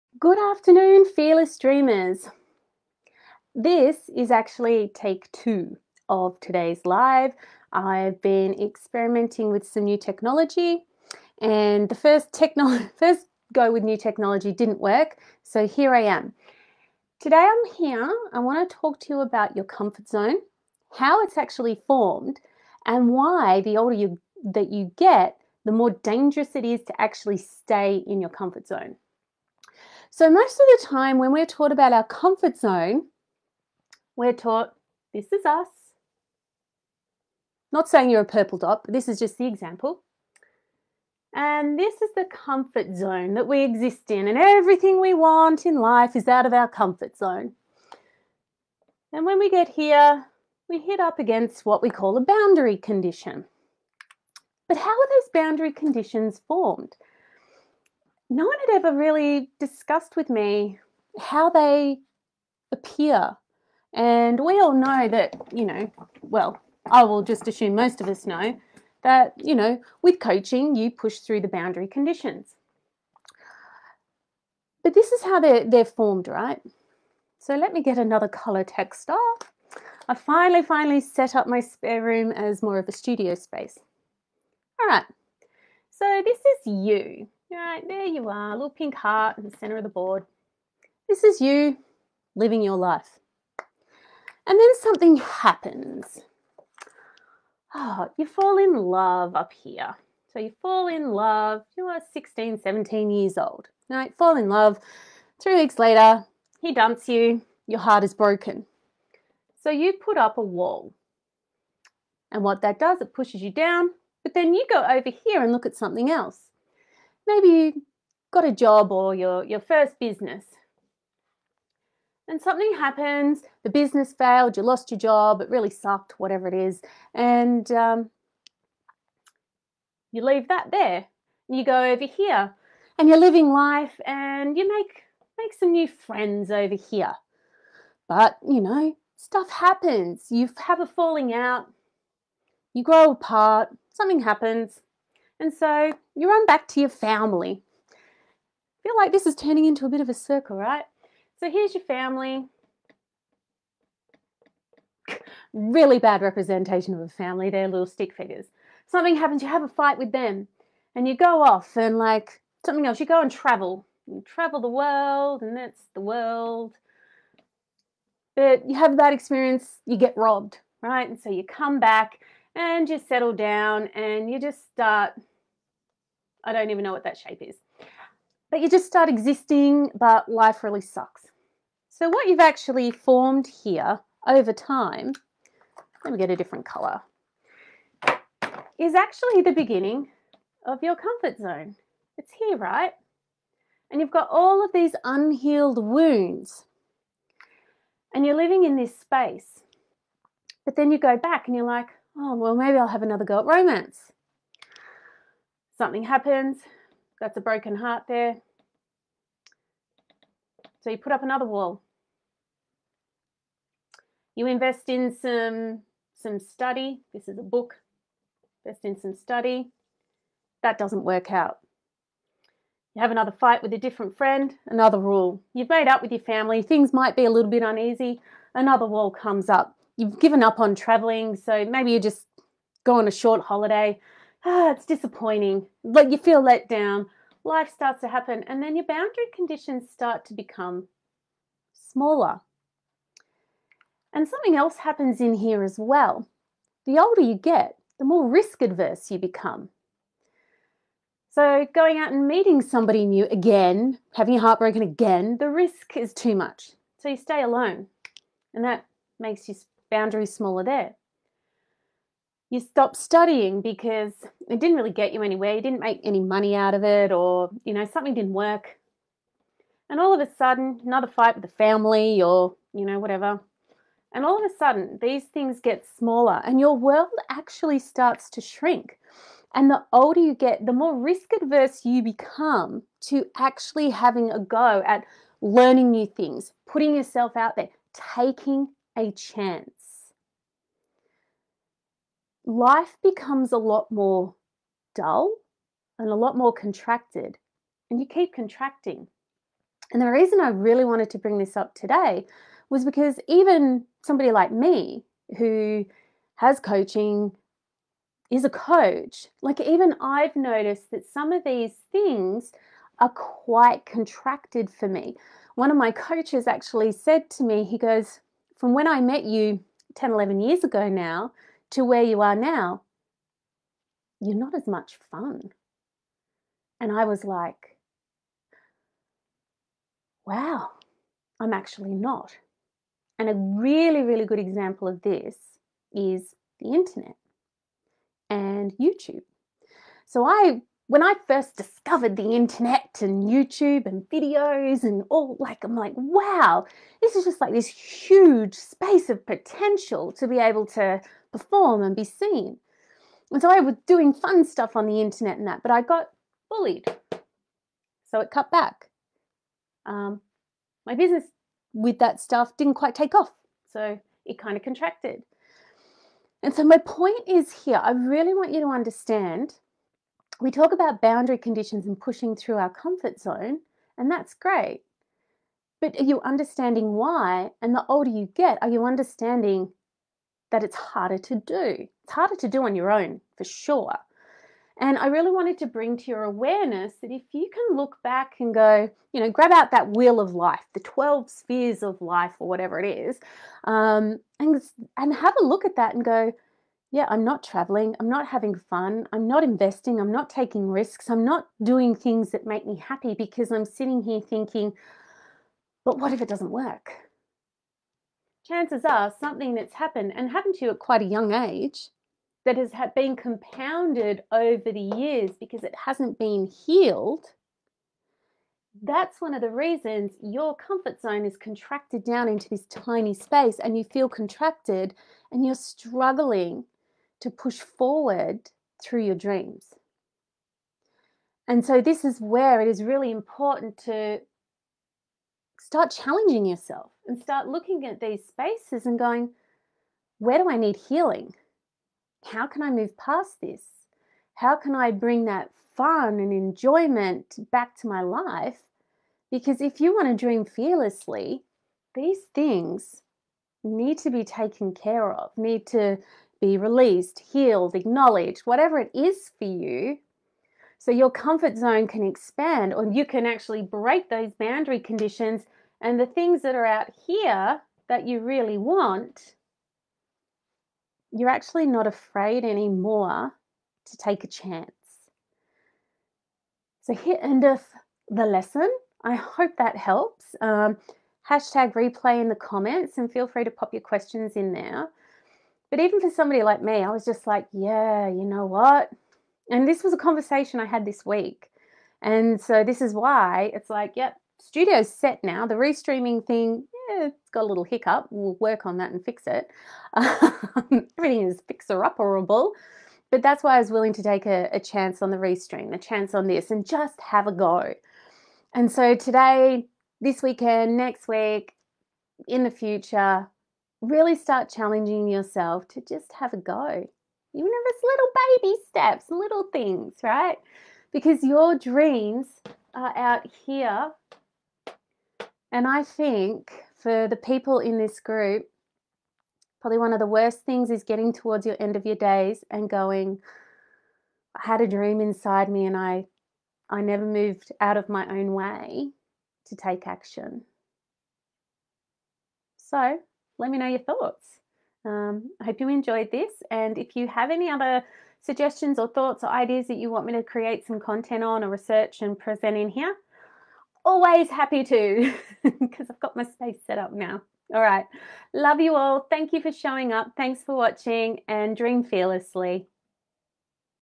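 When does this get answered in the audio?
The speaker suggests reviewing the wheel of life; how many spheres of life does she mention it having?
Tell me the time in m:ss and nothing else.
6:30.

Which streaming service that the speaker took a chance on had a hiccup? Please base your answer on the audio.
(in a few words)
Restream.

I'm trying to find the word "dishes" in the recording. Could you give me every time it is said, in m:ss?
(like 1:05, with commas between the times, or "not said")
not said.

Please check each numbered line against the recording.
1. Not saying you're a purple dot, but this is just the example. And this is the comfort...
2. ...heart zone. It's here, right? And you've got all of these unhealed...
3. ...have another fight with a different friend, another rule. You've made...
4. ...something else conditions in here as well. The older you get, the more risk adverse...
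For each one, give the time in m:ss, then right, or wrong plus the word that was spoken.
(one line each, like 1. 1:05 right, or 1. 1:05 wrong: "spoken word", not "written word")
1. 0:37 right
2. 3:10 wrong: "comfort", not "heart"
3. 3:43 right
4. 4:04 wrong: "happens", not "conditions".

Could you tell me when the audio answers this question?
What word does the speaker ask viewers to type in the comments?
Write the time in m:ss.
8:01.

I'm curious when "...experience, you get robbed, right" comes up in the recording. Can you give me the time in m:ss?
2:49.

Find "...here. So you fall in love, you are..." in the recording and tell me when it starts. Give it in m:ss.
1:39.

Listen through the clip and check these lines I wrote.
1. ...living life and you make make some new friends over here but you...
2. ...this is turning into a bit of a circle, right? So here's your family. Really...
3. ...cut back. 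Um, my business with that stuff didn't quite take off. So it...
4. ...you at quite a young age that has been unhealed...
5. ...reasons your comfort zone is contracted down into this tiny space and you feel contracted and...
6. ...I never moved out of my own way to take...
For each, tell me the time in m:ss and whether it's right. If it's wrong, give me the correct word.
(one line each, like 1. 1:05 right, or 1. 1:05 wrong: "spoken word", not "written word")
1. 2:13 right
2. 2:29 right
3. 5:58 right
4. 6:50 wrong: "compounded", not "unhealed"
5. 6:59 right
6. 8:56 right.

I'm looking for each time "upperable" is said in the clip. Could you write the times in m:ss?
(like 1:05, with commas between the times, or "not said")
8:21.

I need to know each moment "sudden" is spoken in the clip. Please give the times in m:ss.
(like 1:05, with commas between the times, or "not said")
4:30, 4:34.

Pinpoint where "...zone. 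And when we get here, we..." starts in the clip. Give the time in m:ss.
0:47.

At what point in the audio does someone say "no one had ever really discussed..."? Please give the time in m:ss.
0:58.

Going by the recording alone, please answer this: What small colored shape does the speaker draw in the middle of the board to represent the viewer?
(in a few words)
Pink heart.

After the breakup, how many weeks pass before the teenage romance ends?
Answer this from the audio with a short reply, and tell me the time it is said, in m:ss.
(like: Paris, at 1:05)
3, at 1:45.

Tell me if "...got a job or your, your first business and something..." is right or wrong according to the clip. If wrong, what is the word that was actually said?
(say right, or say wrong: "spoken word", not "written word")
right.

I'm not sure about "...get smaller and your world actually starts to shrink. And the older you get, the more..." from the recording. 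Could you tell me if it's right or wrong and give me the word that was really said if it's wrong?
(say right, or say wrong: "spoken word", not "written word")
right.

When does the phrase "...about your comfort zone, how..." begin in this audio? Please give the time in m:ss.
0:19.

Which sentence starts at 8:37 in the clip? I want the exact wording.
Even if it's little baby steps, little things, right?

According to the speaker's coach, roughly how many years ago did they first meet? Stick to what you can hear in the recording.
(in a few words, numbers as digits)
10 or 11 years.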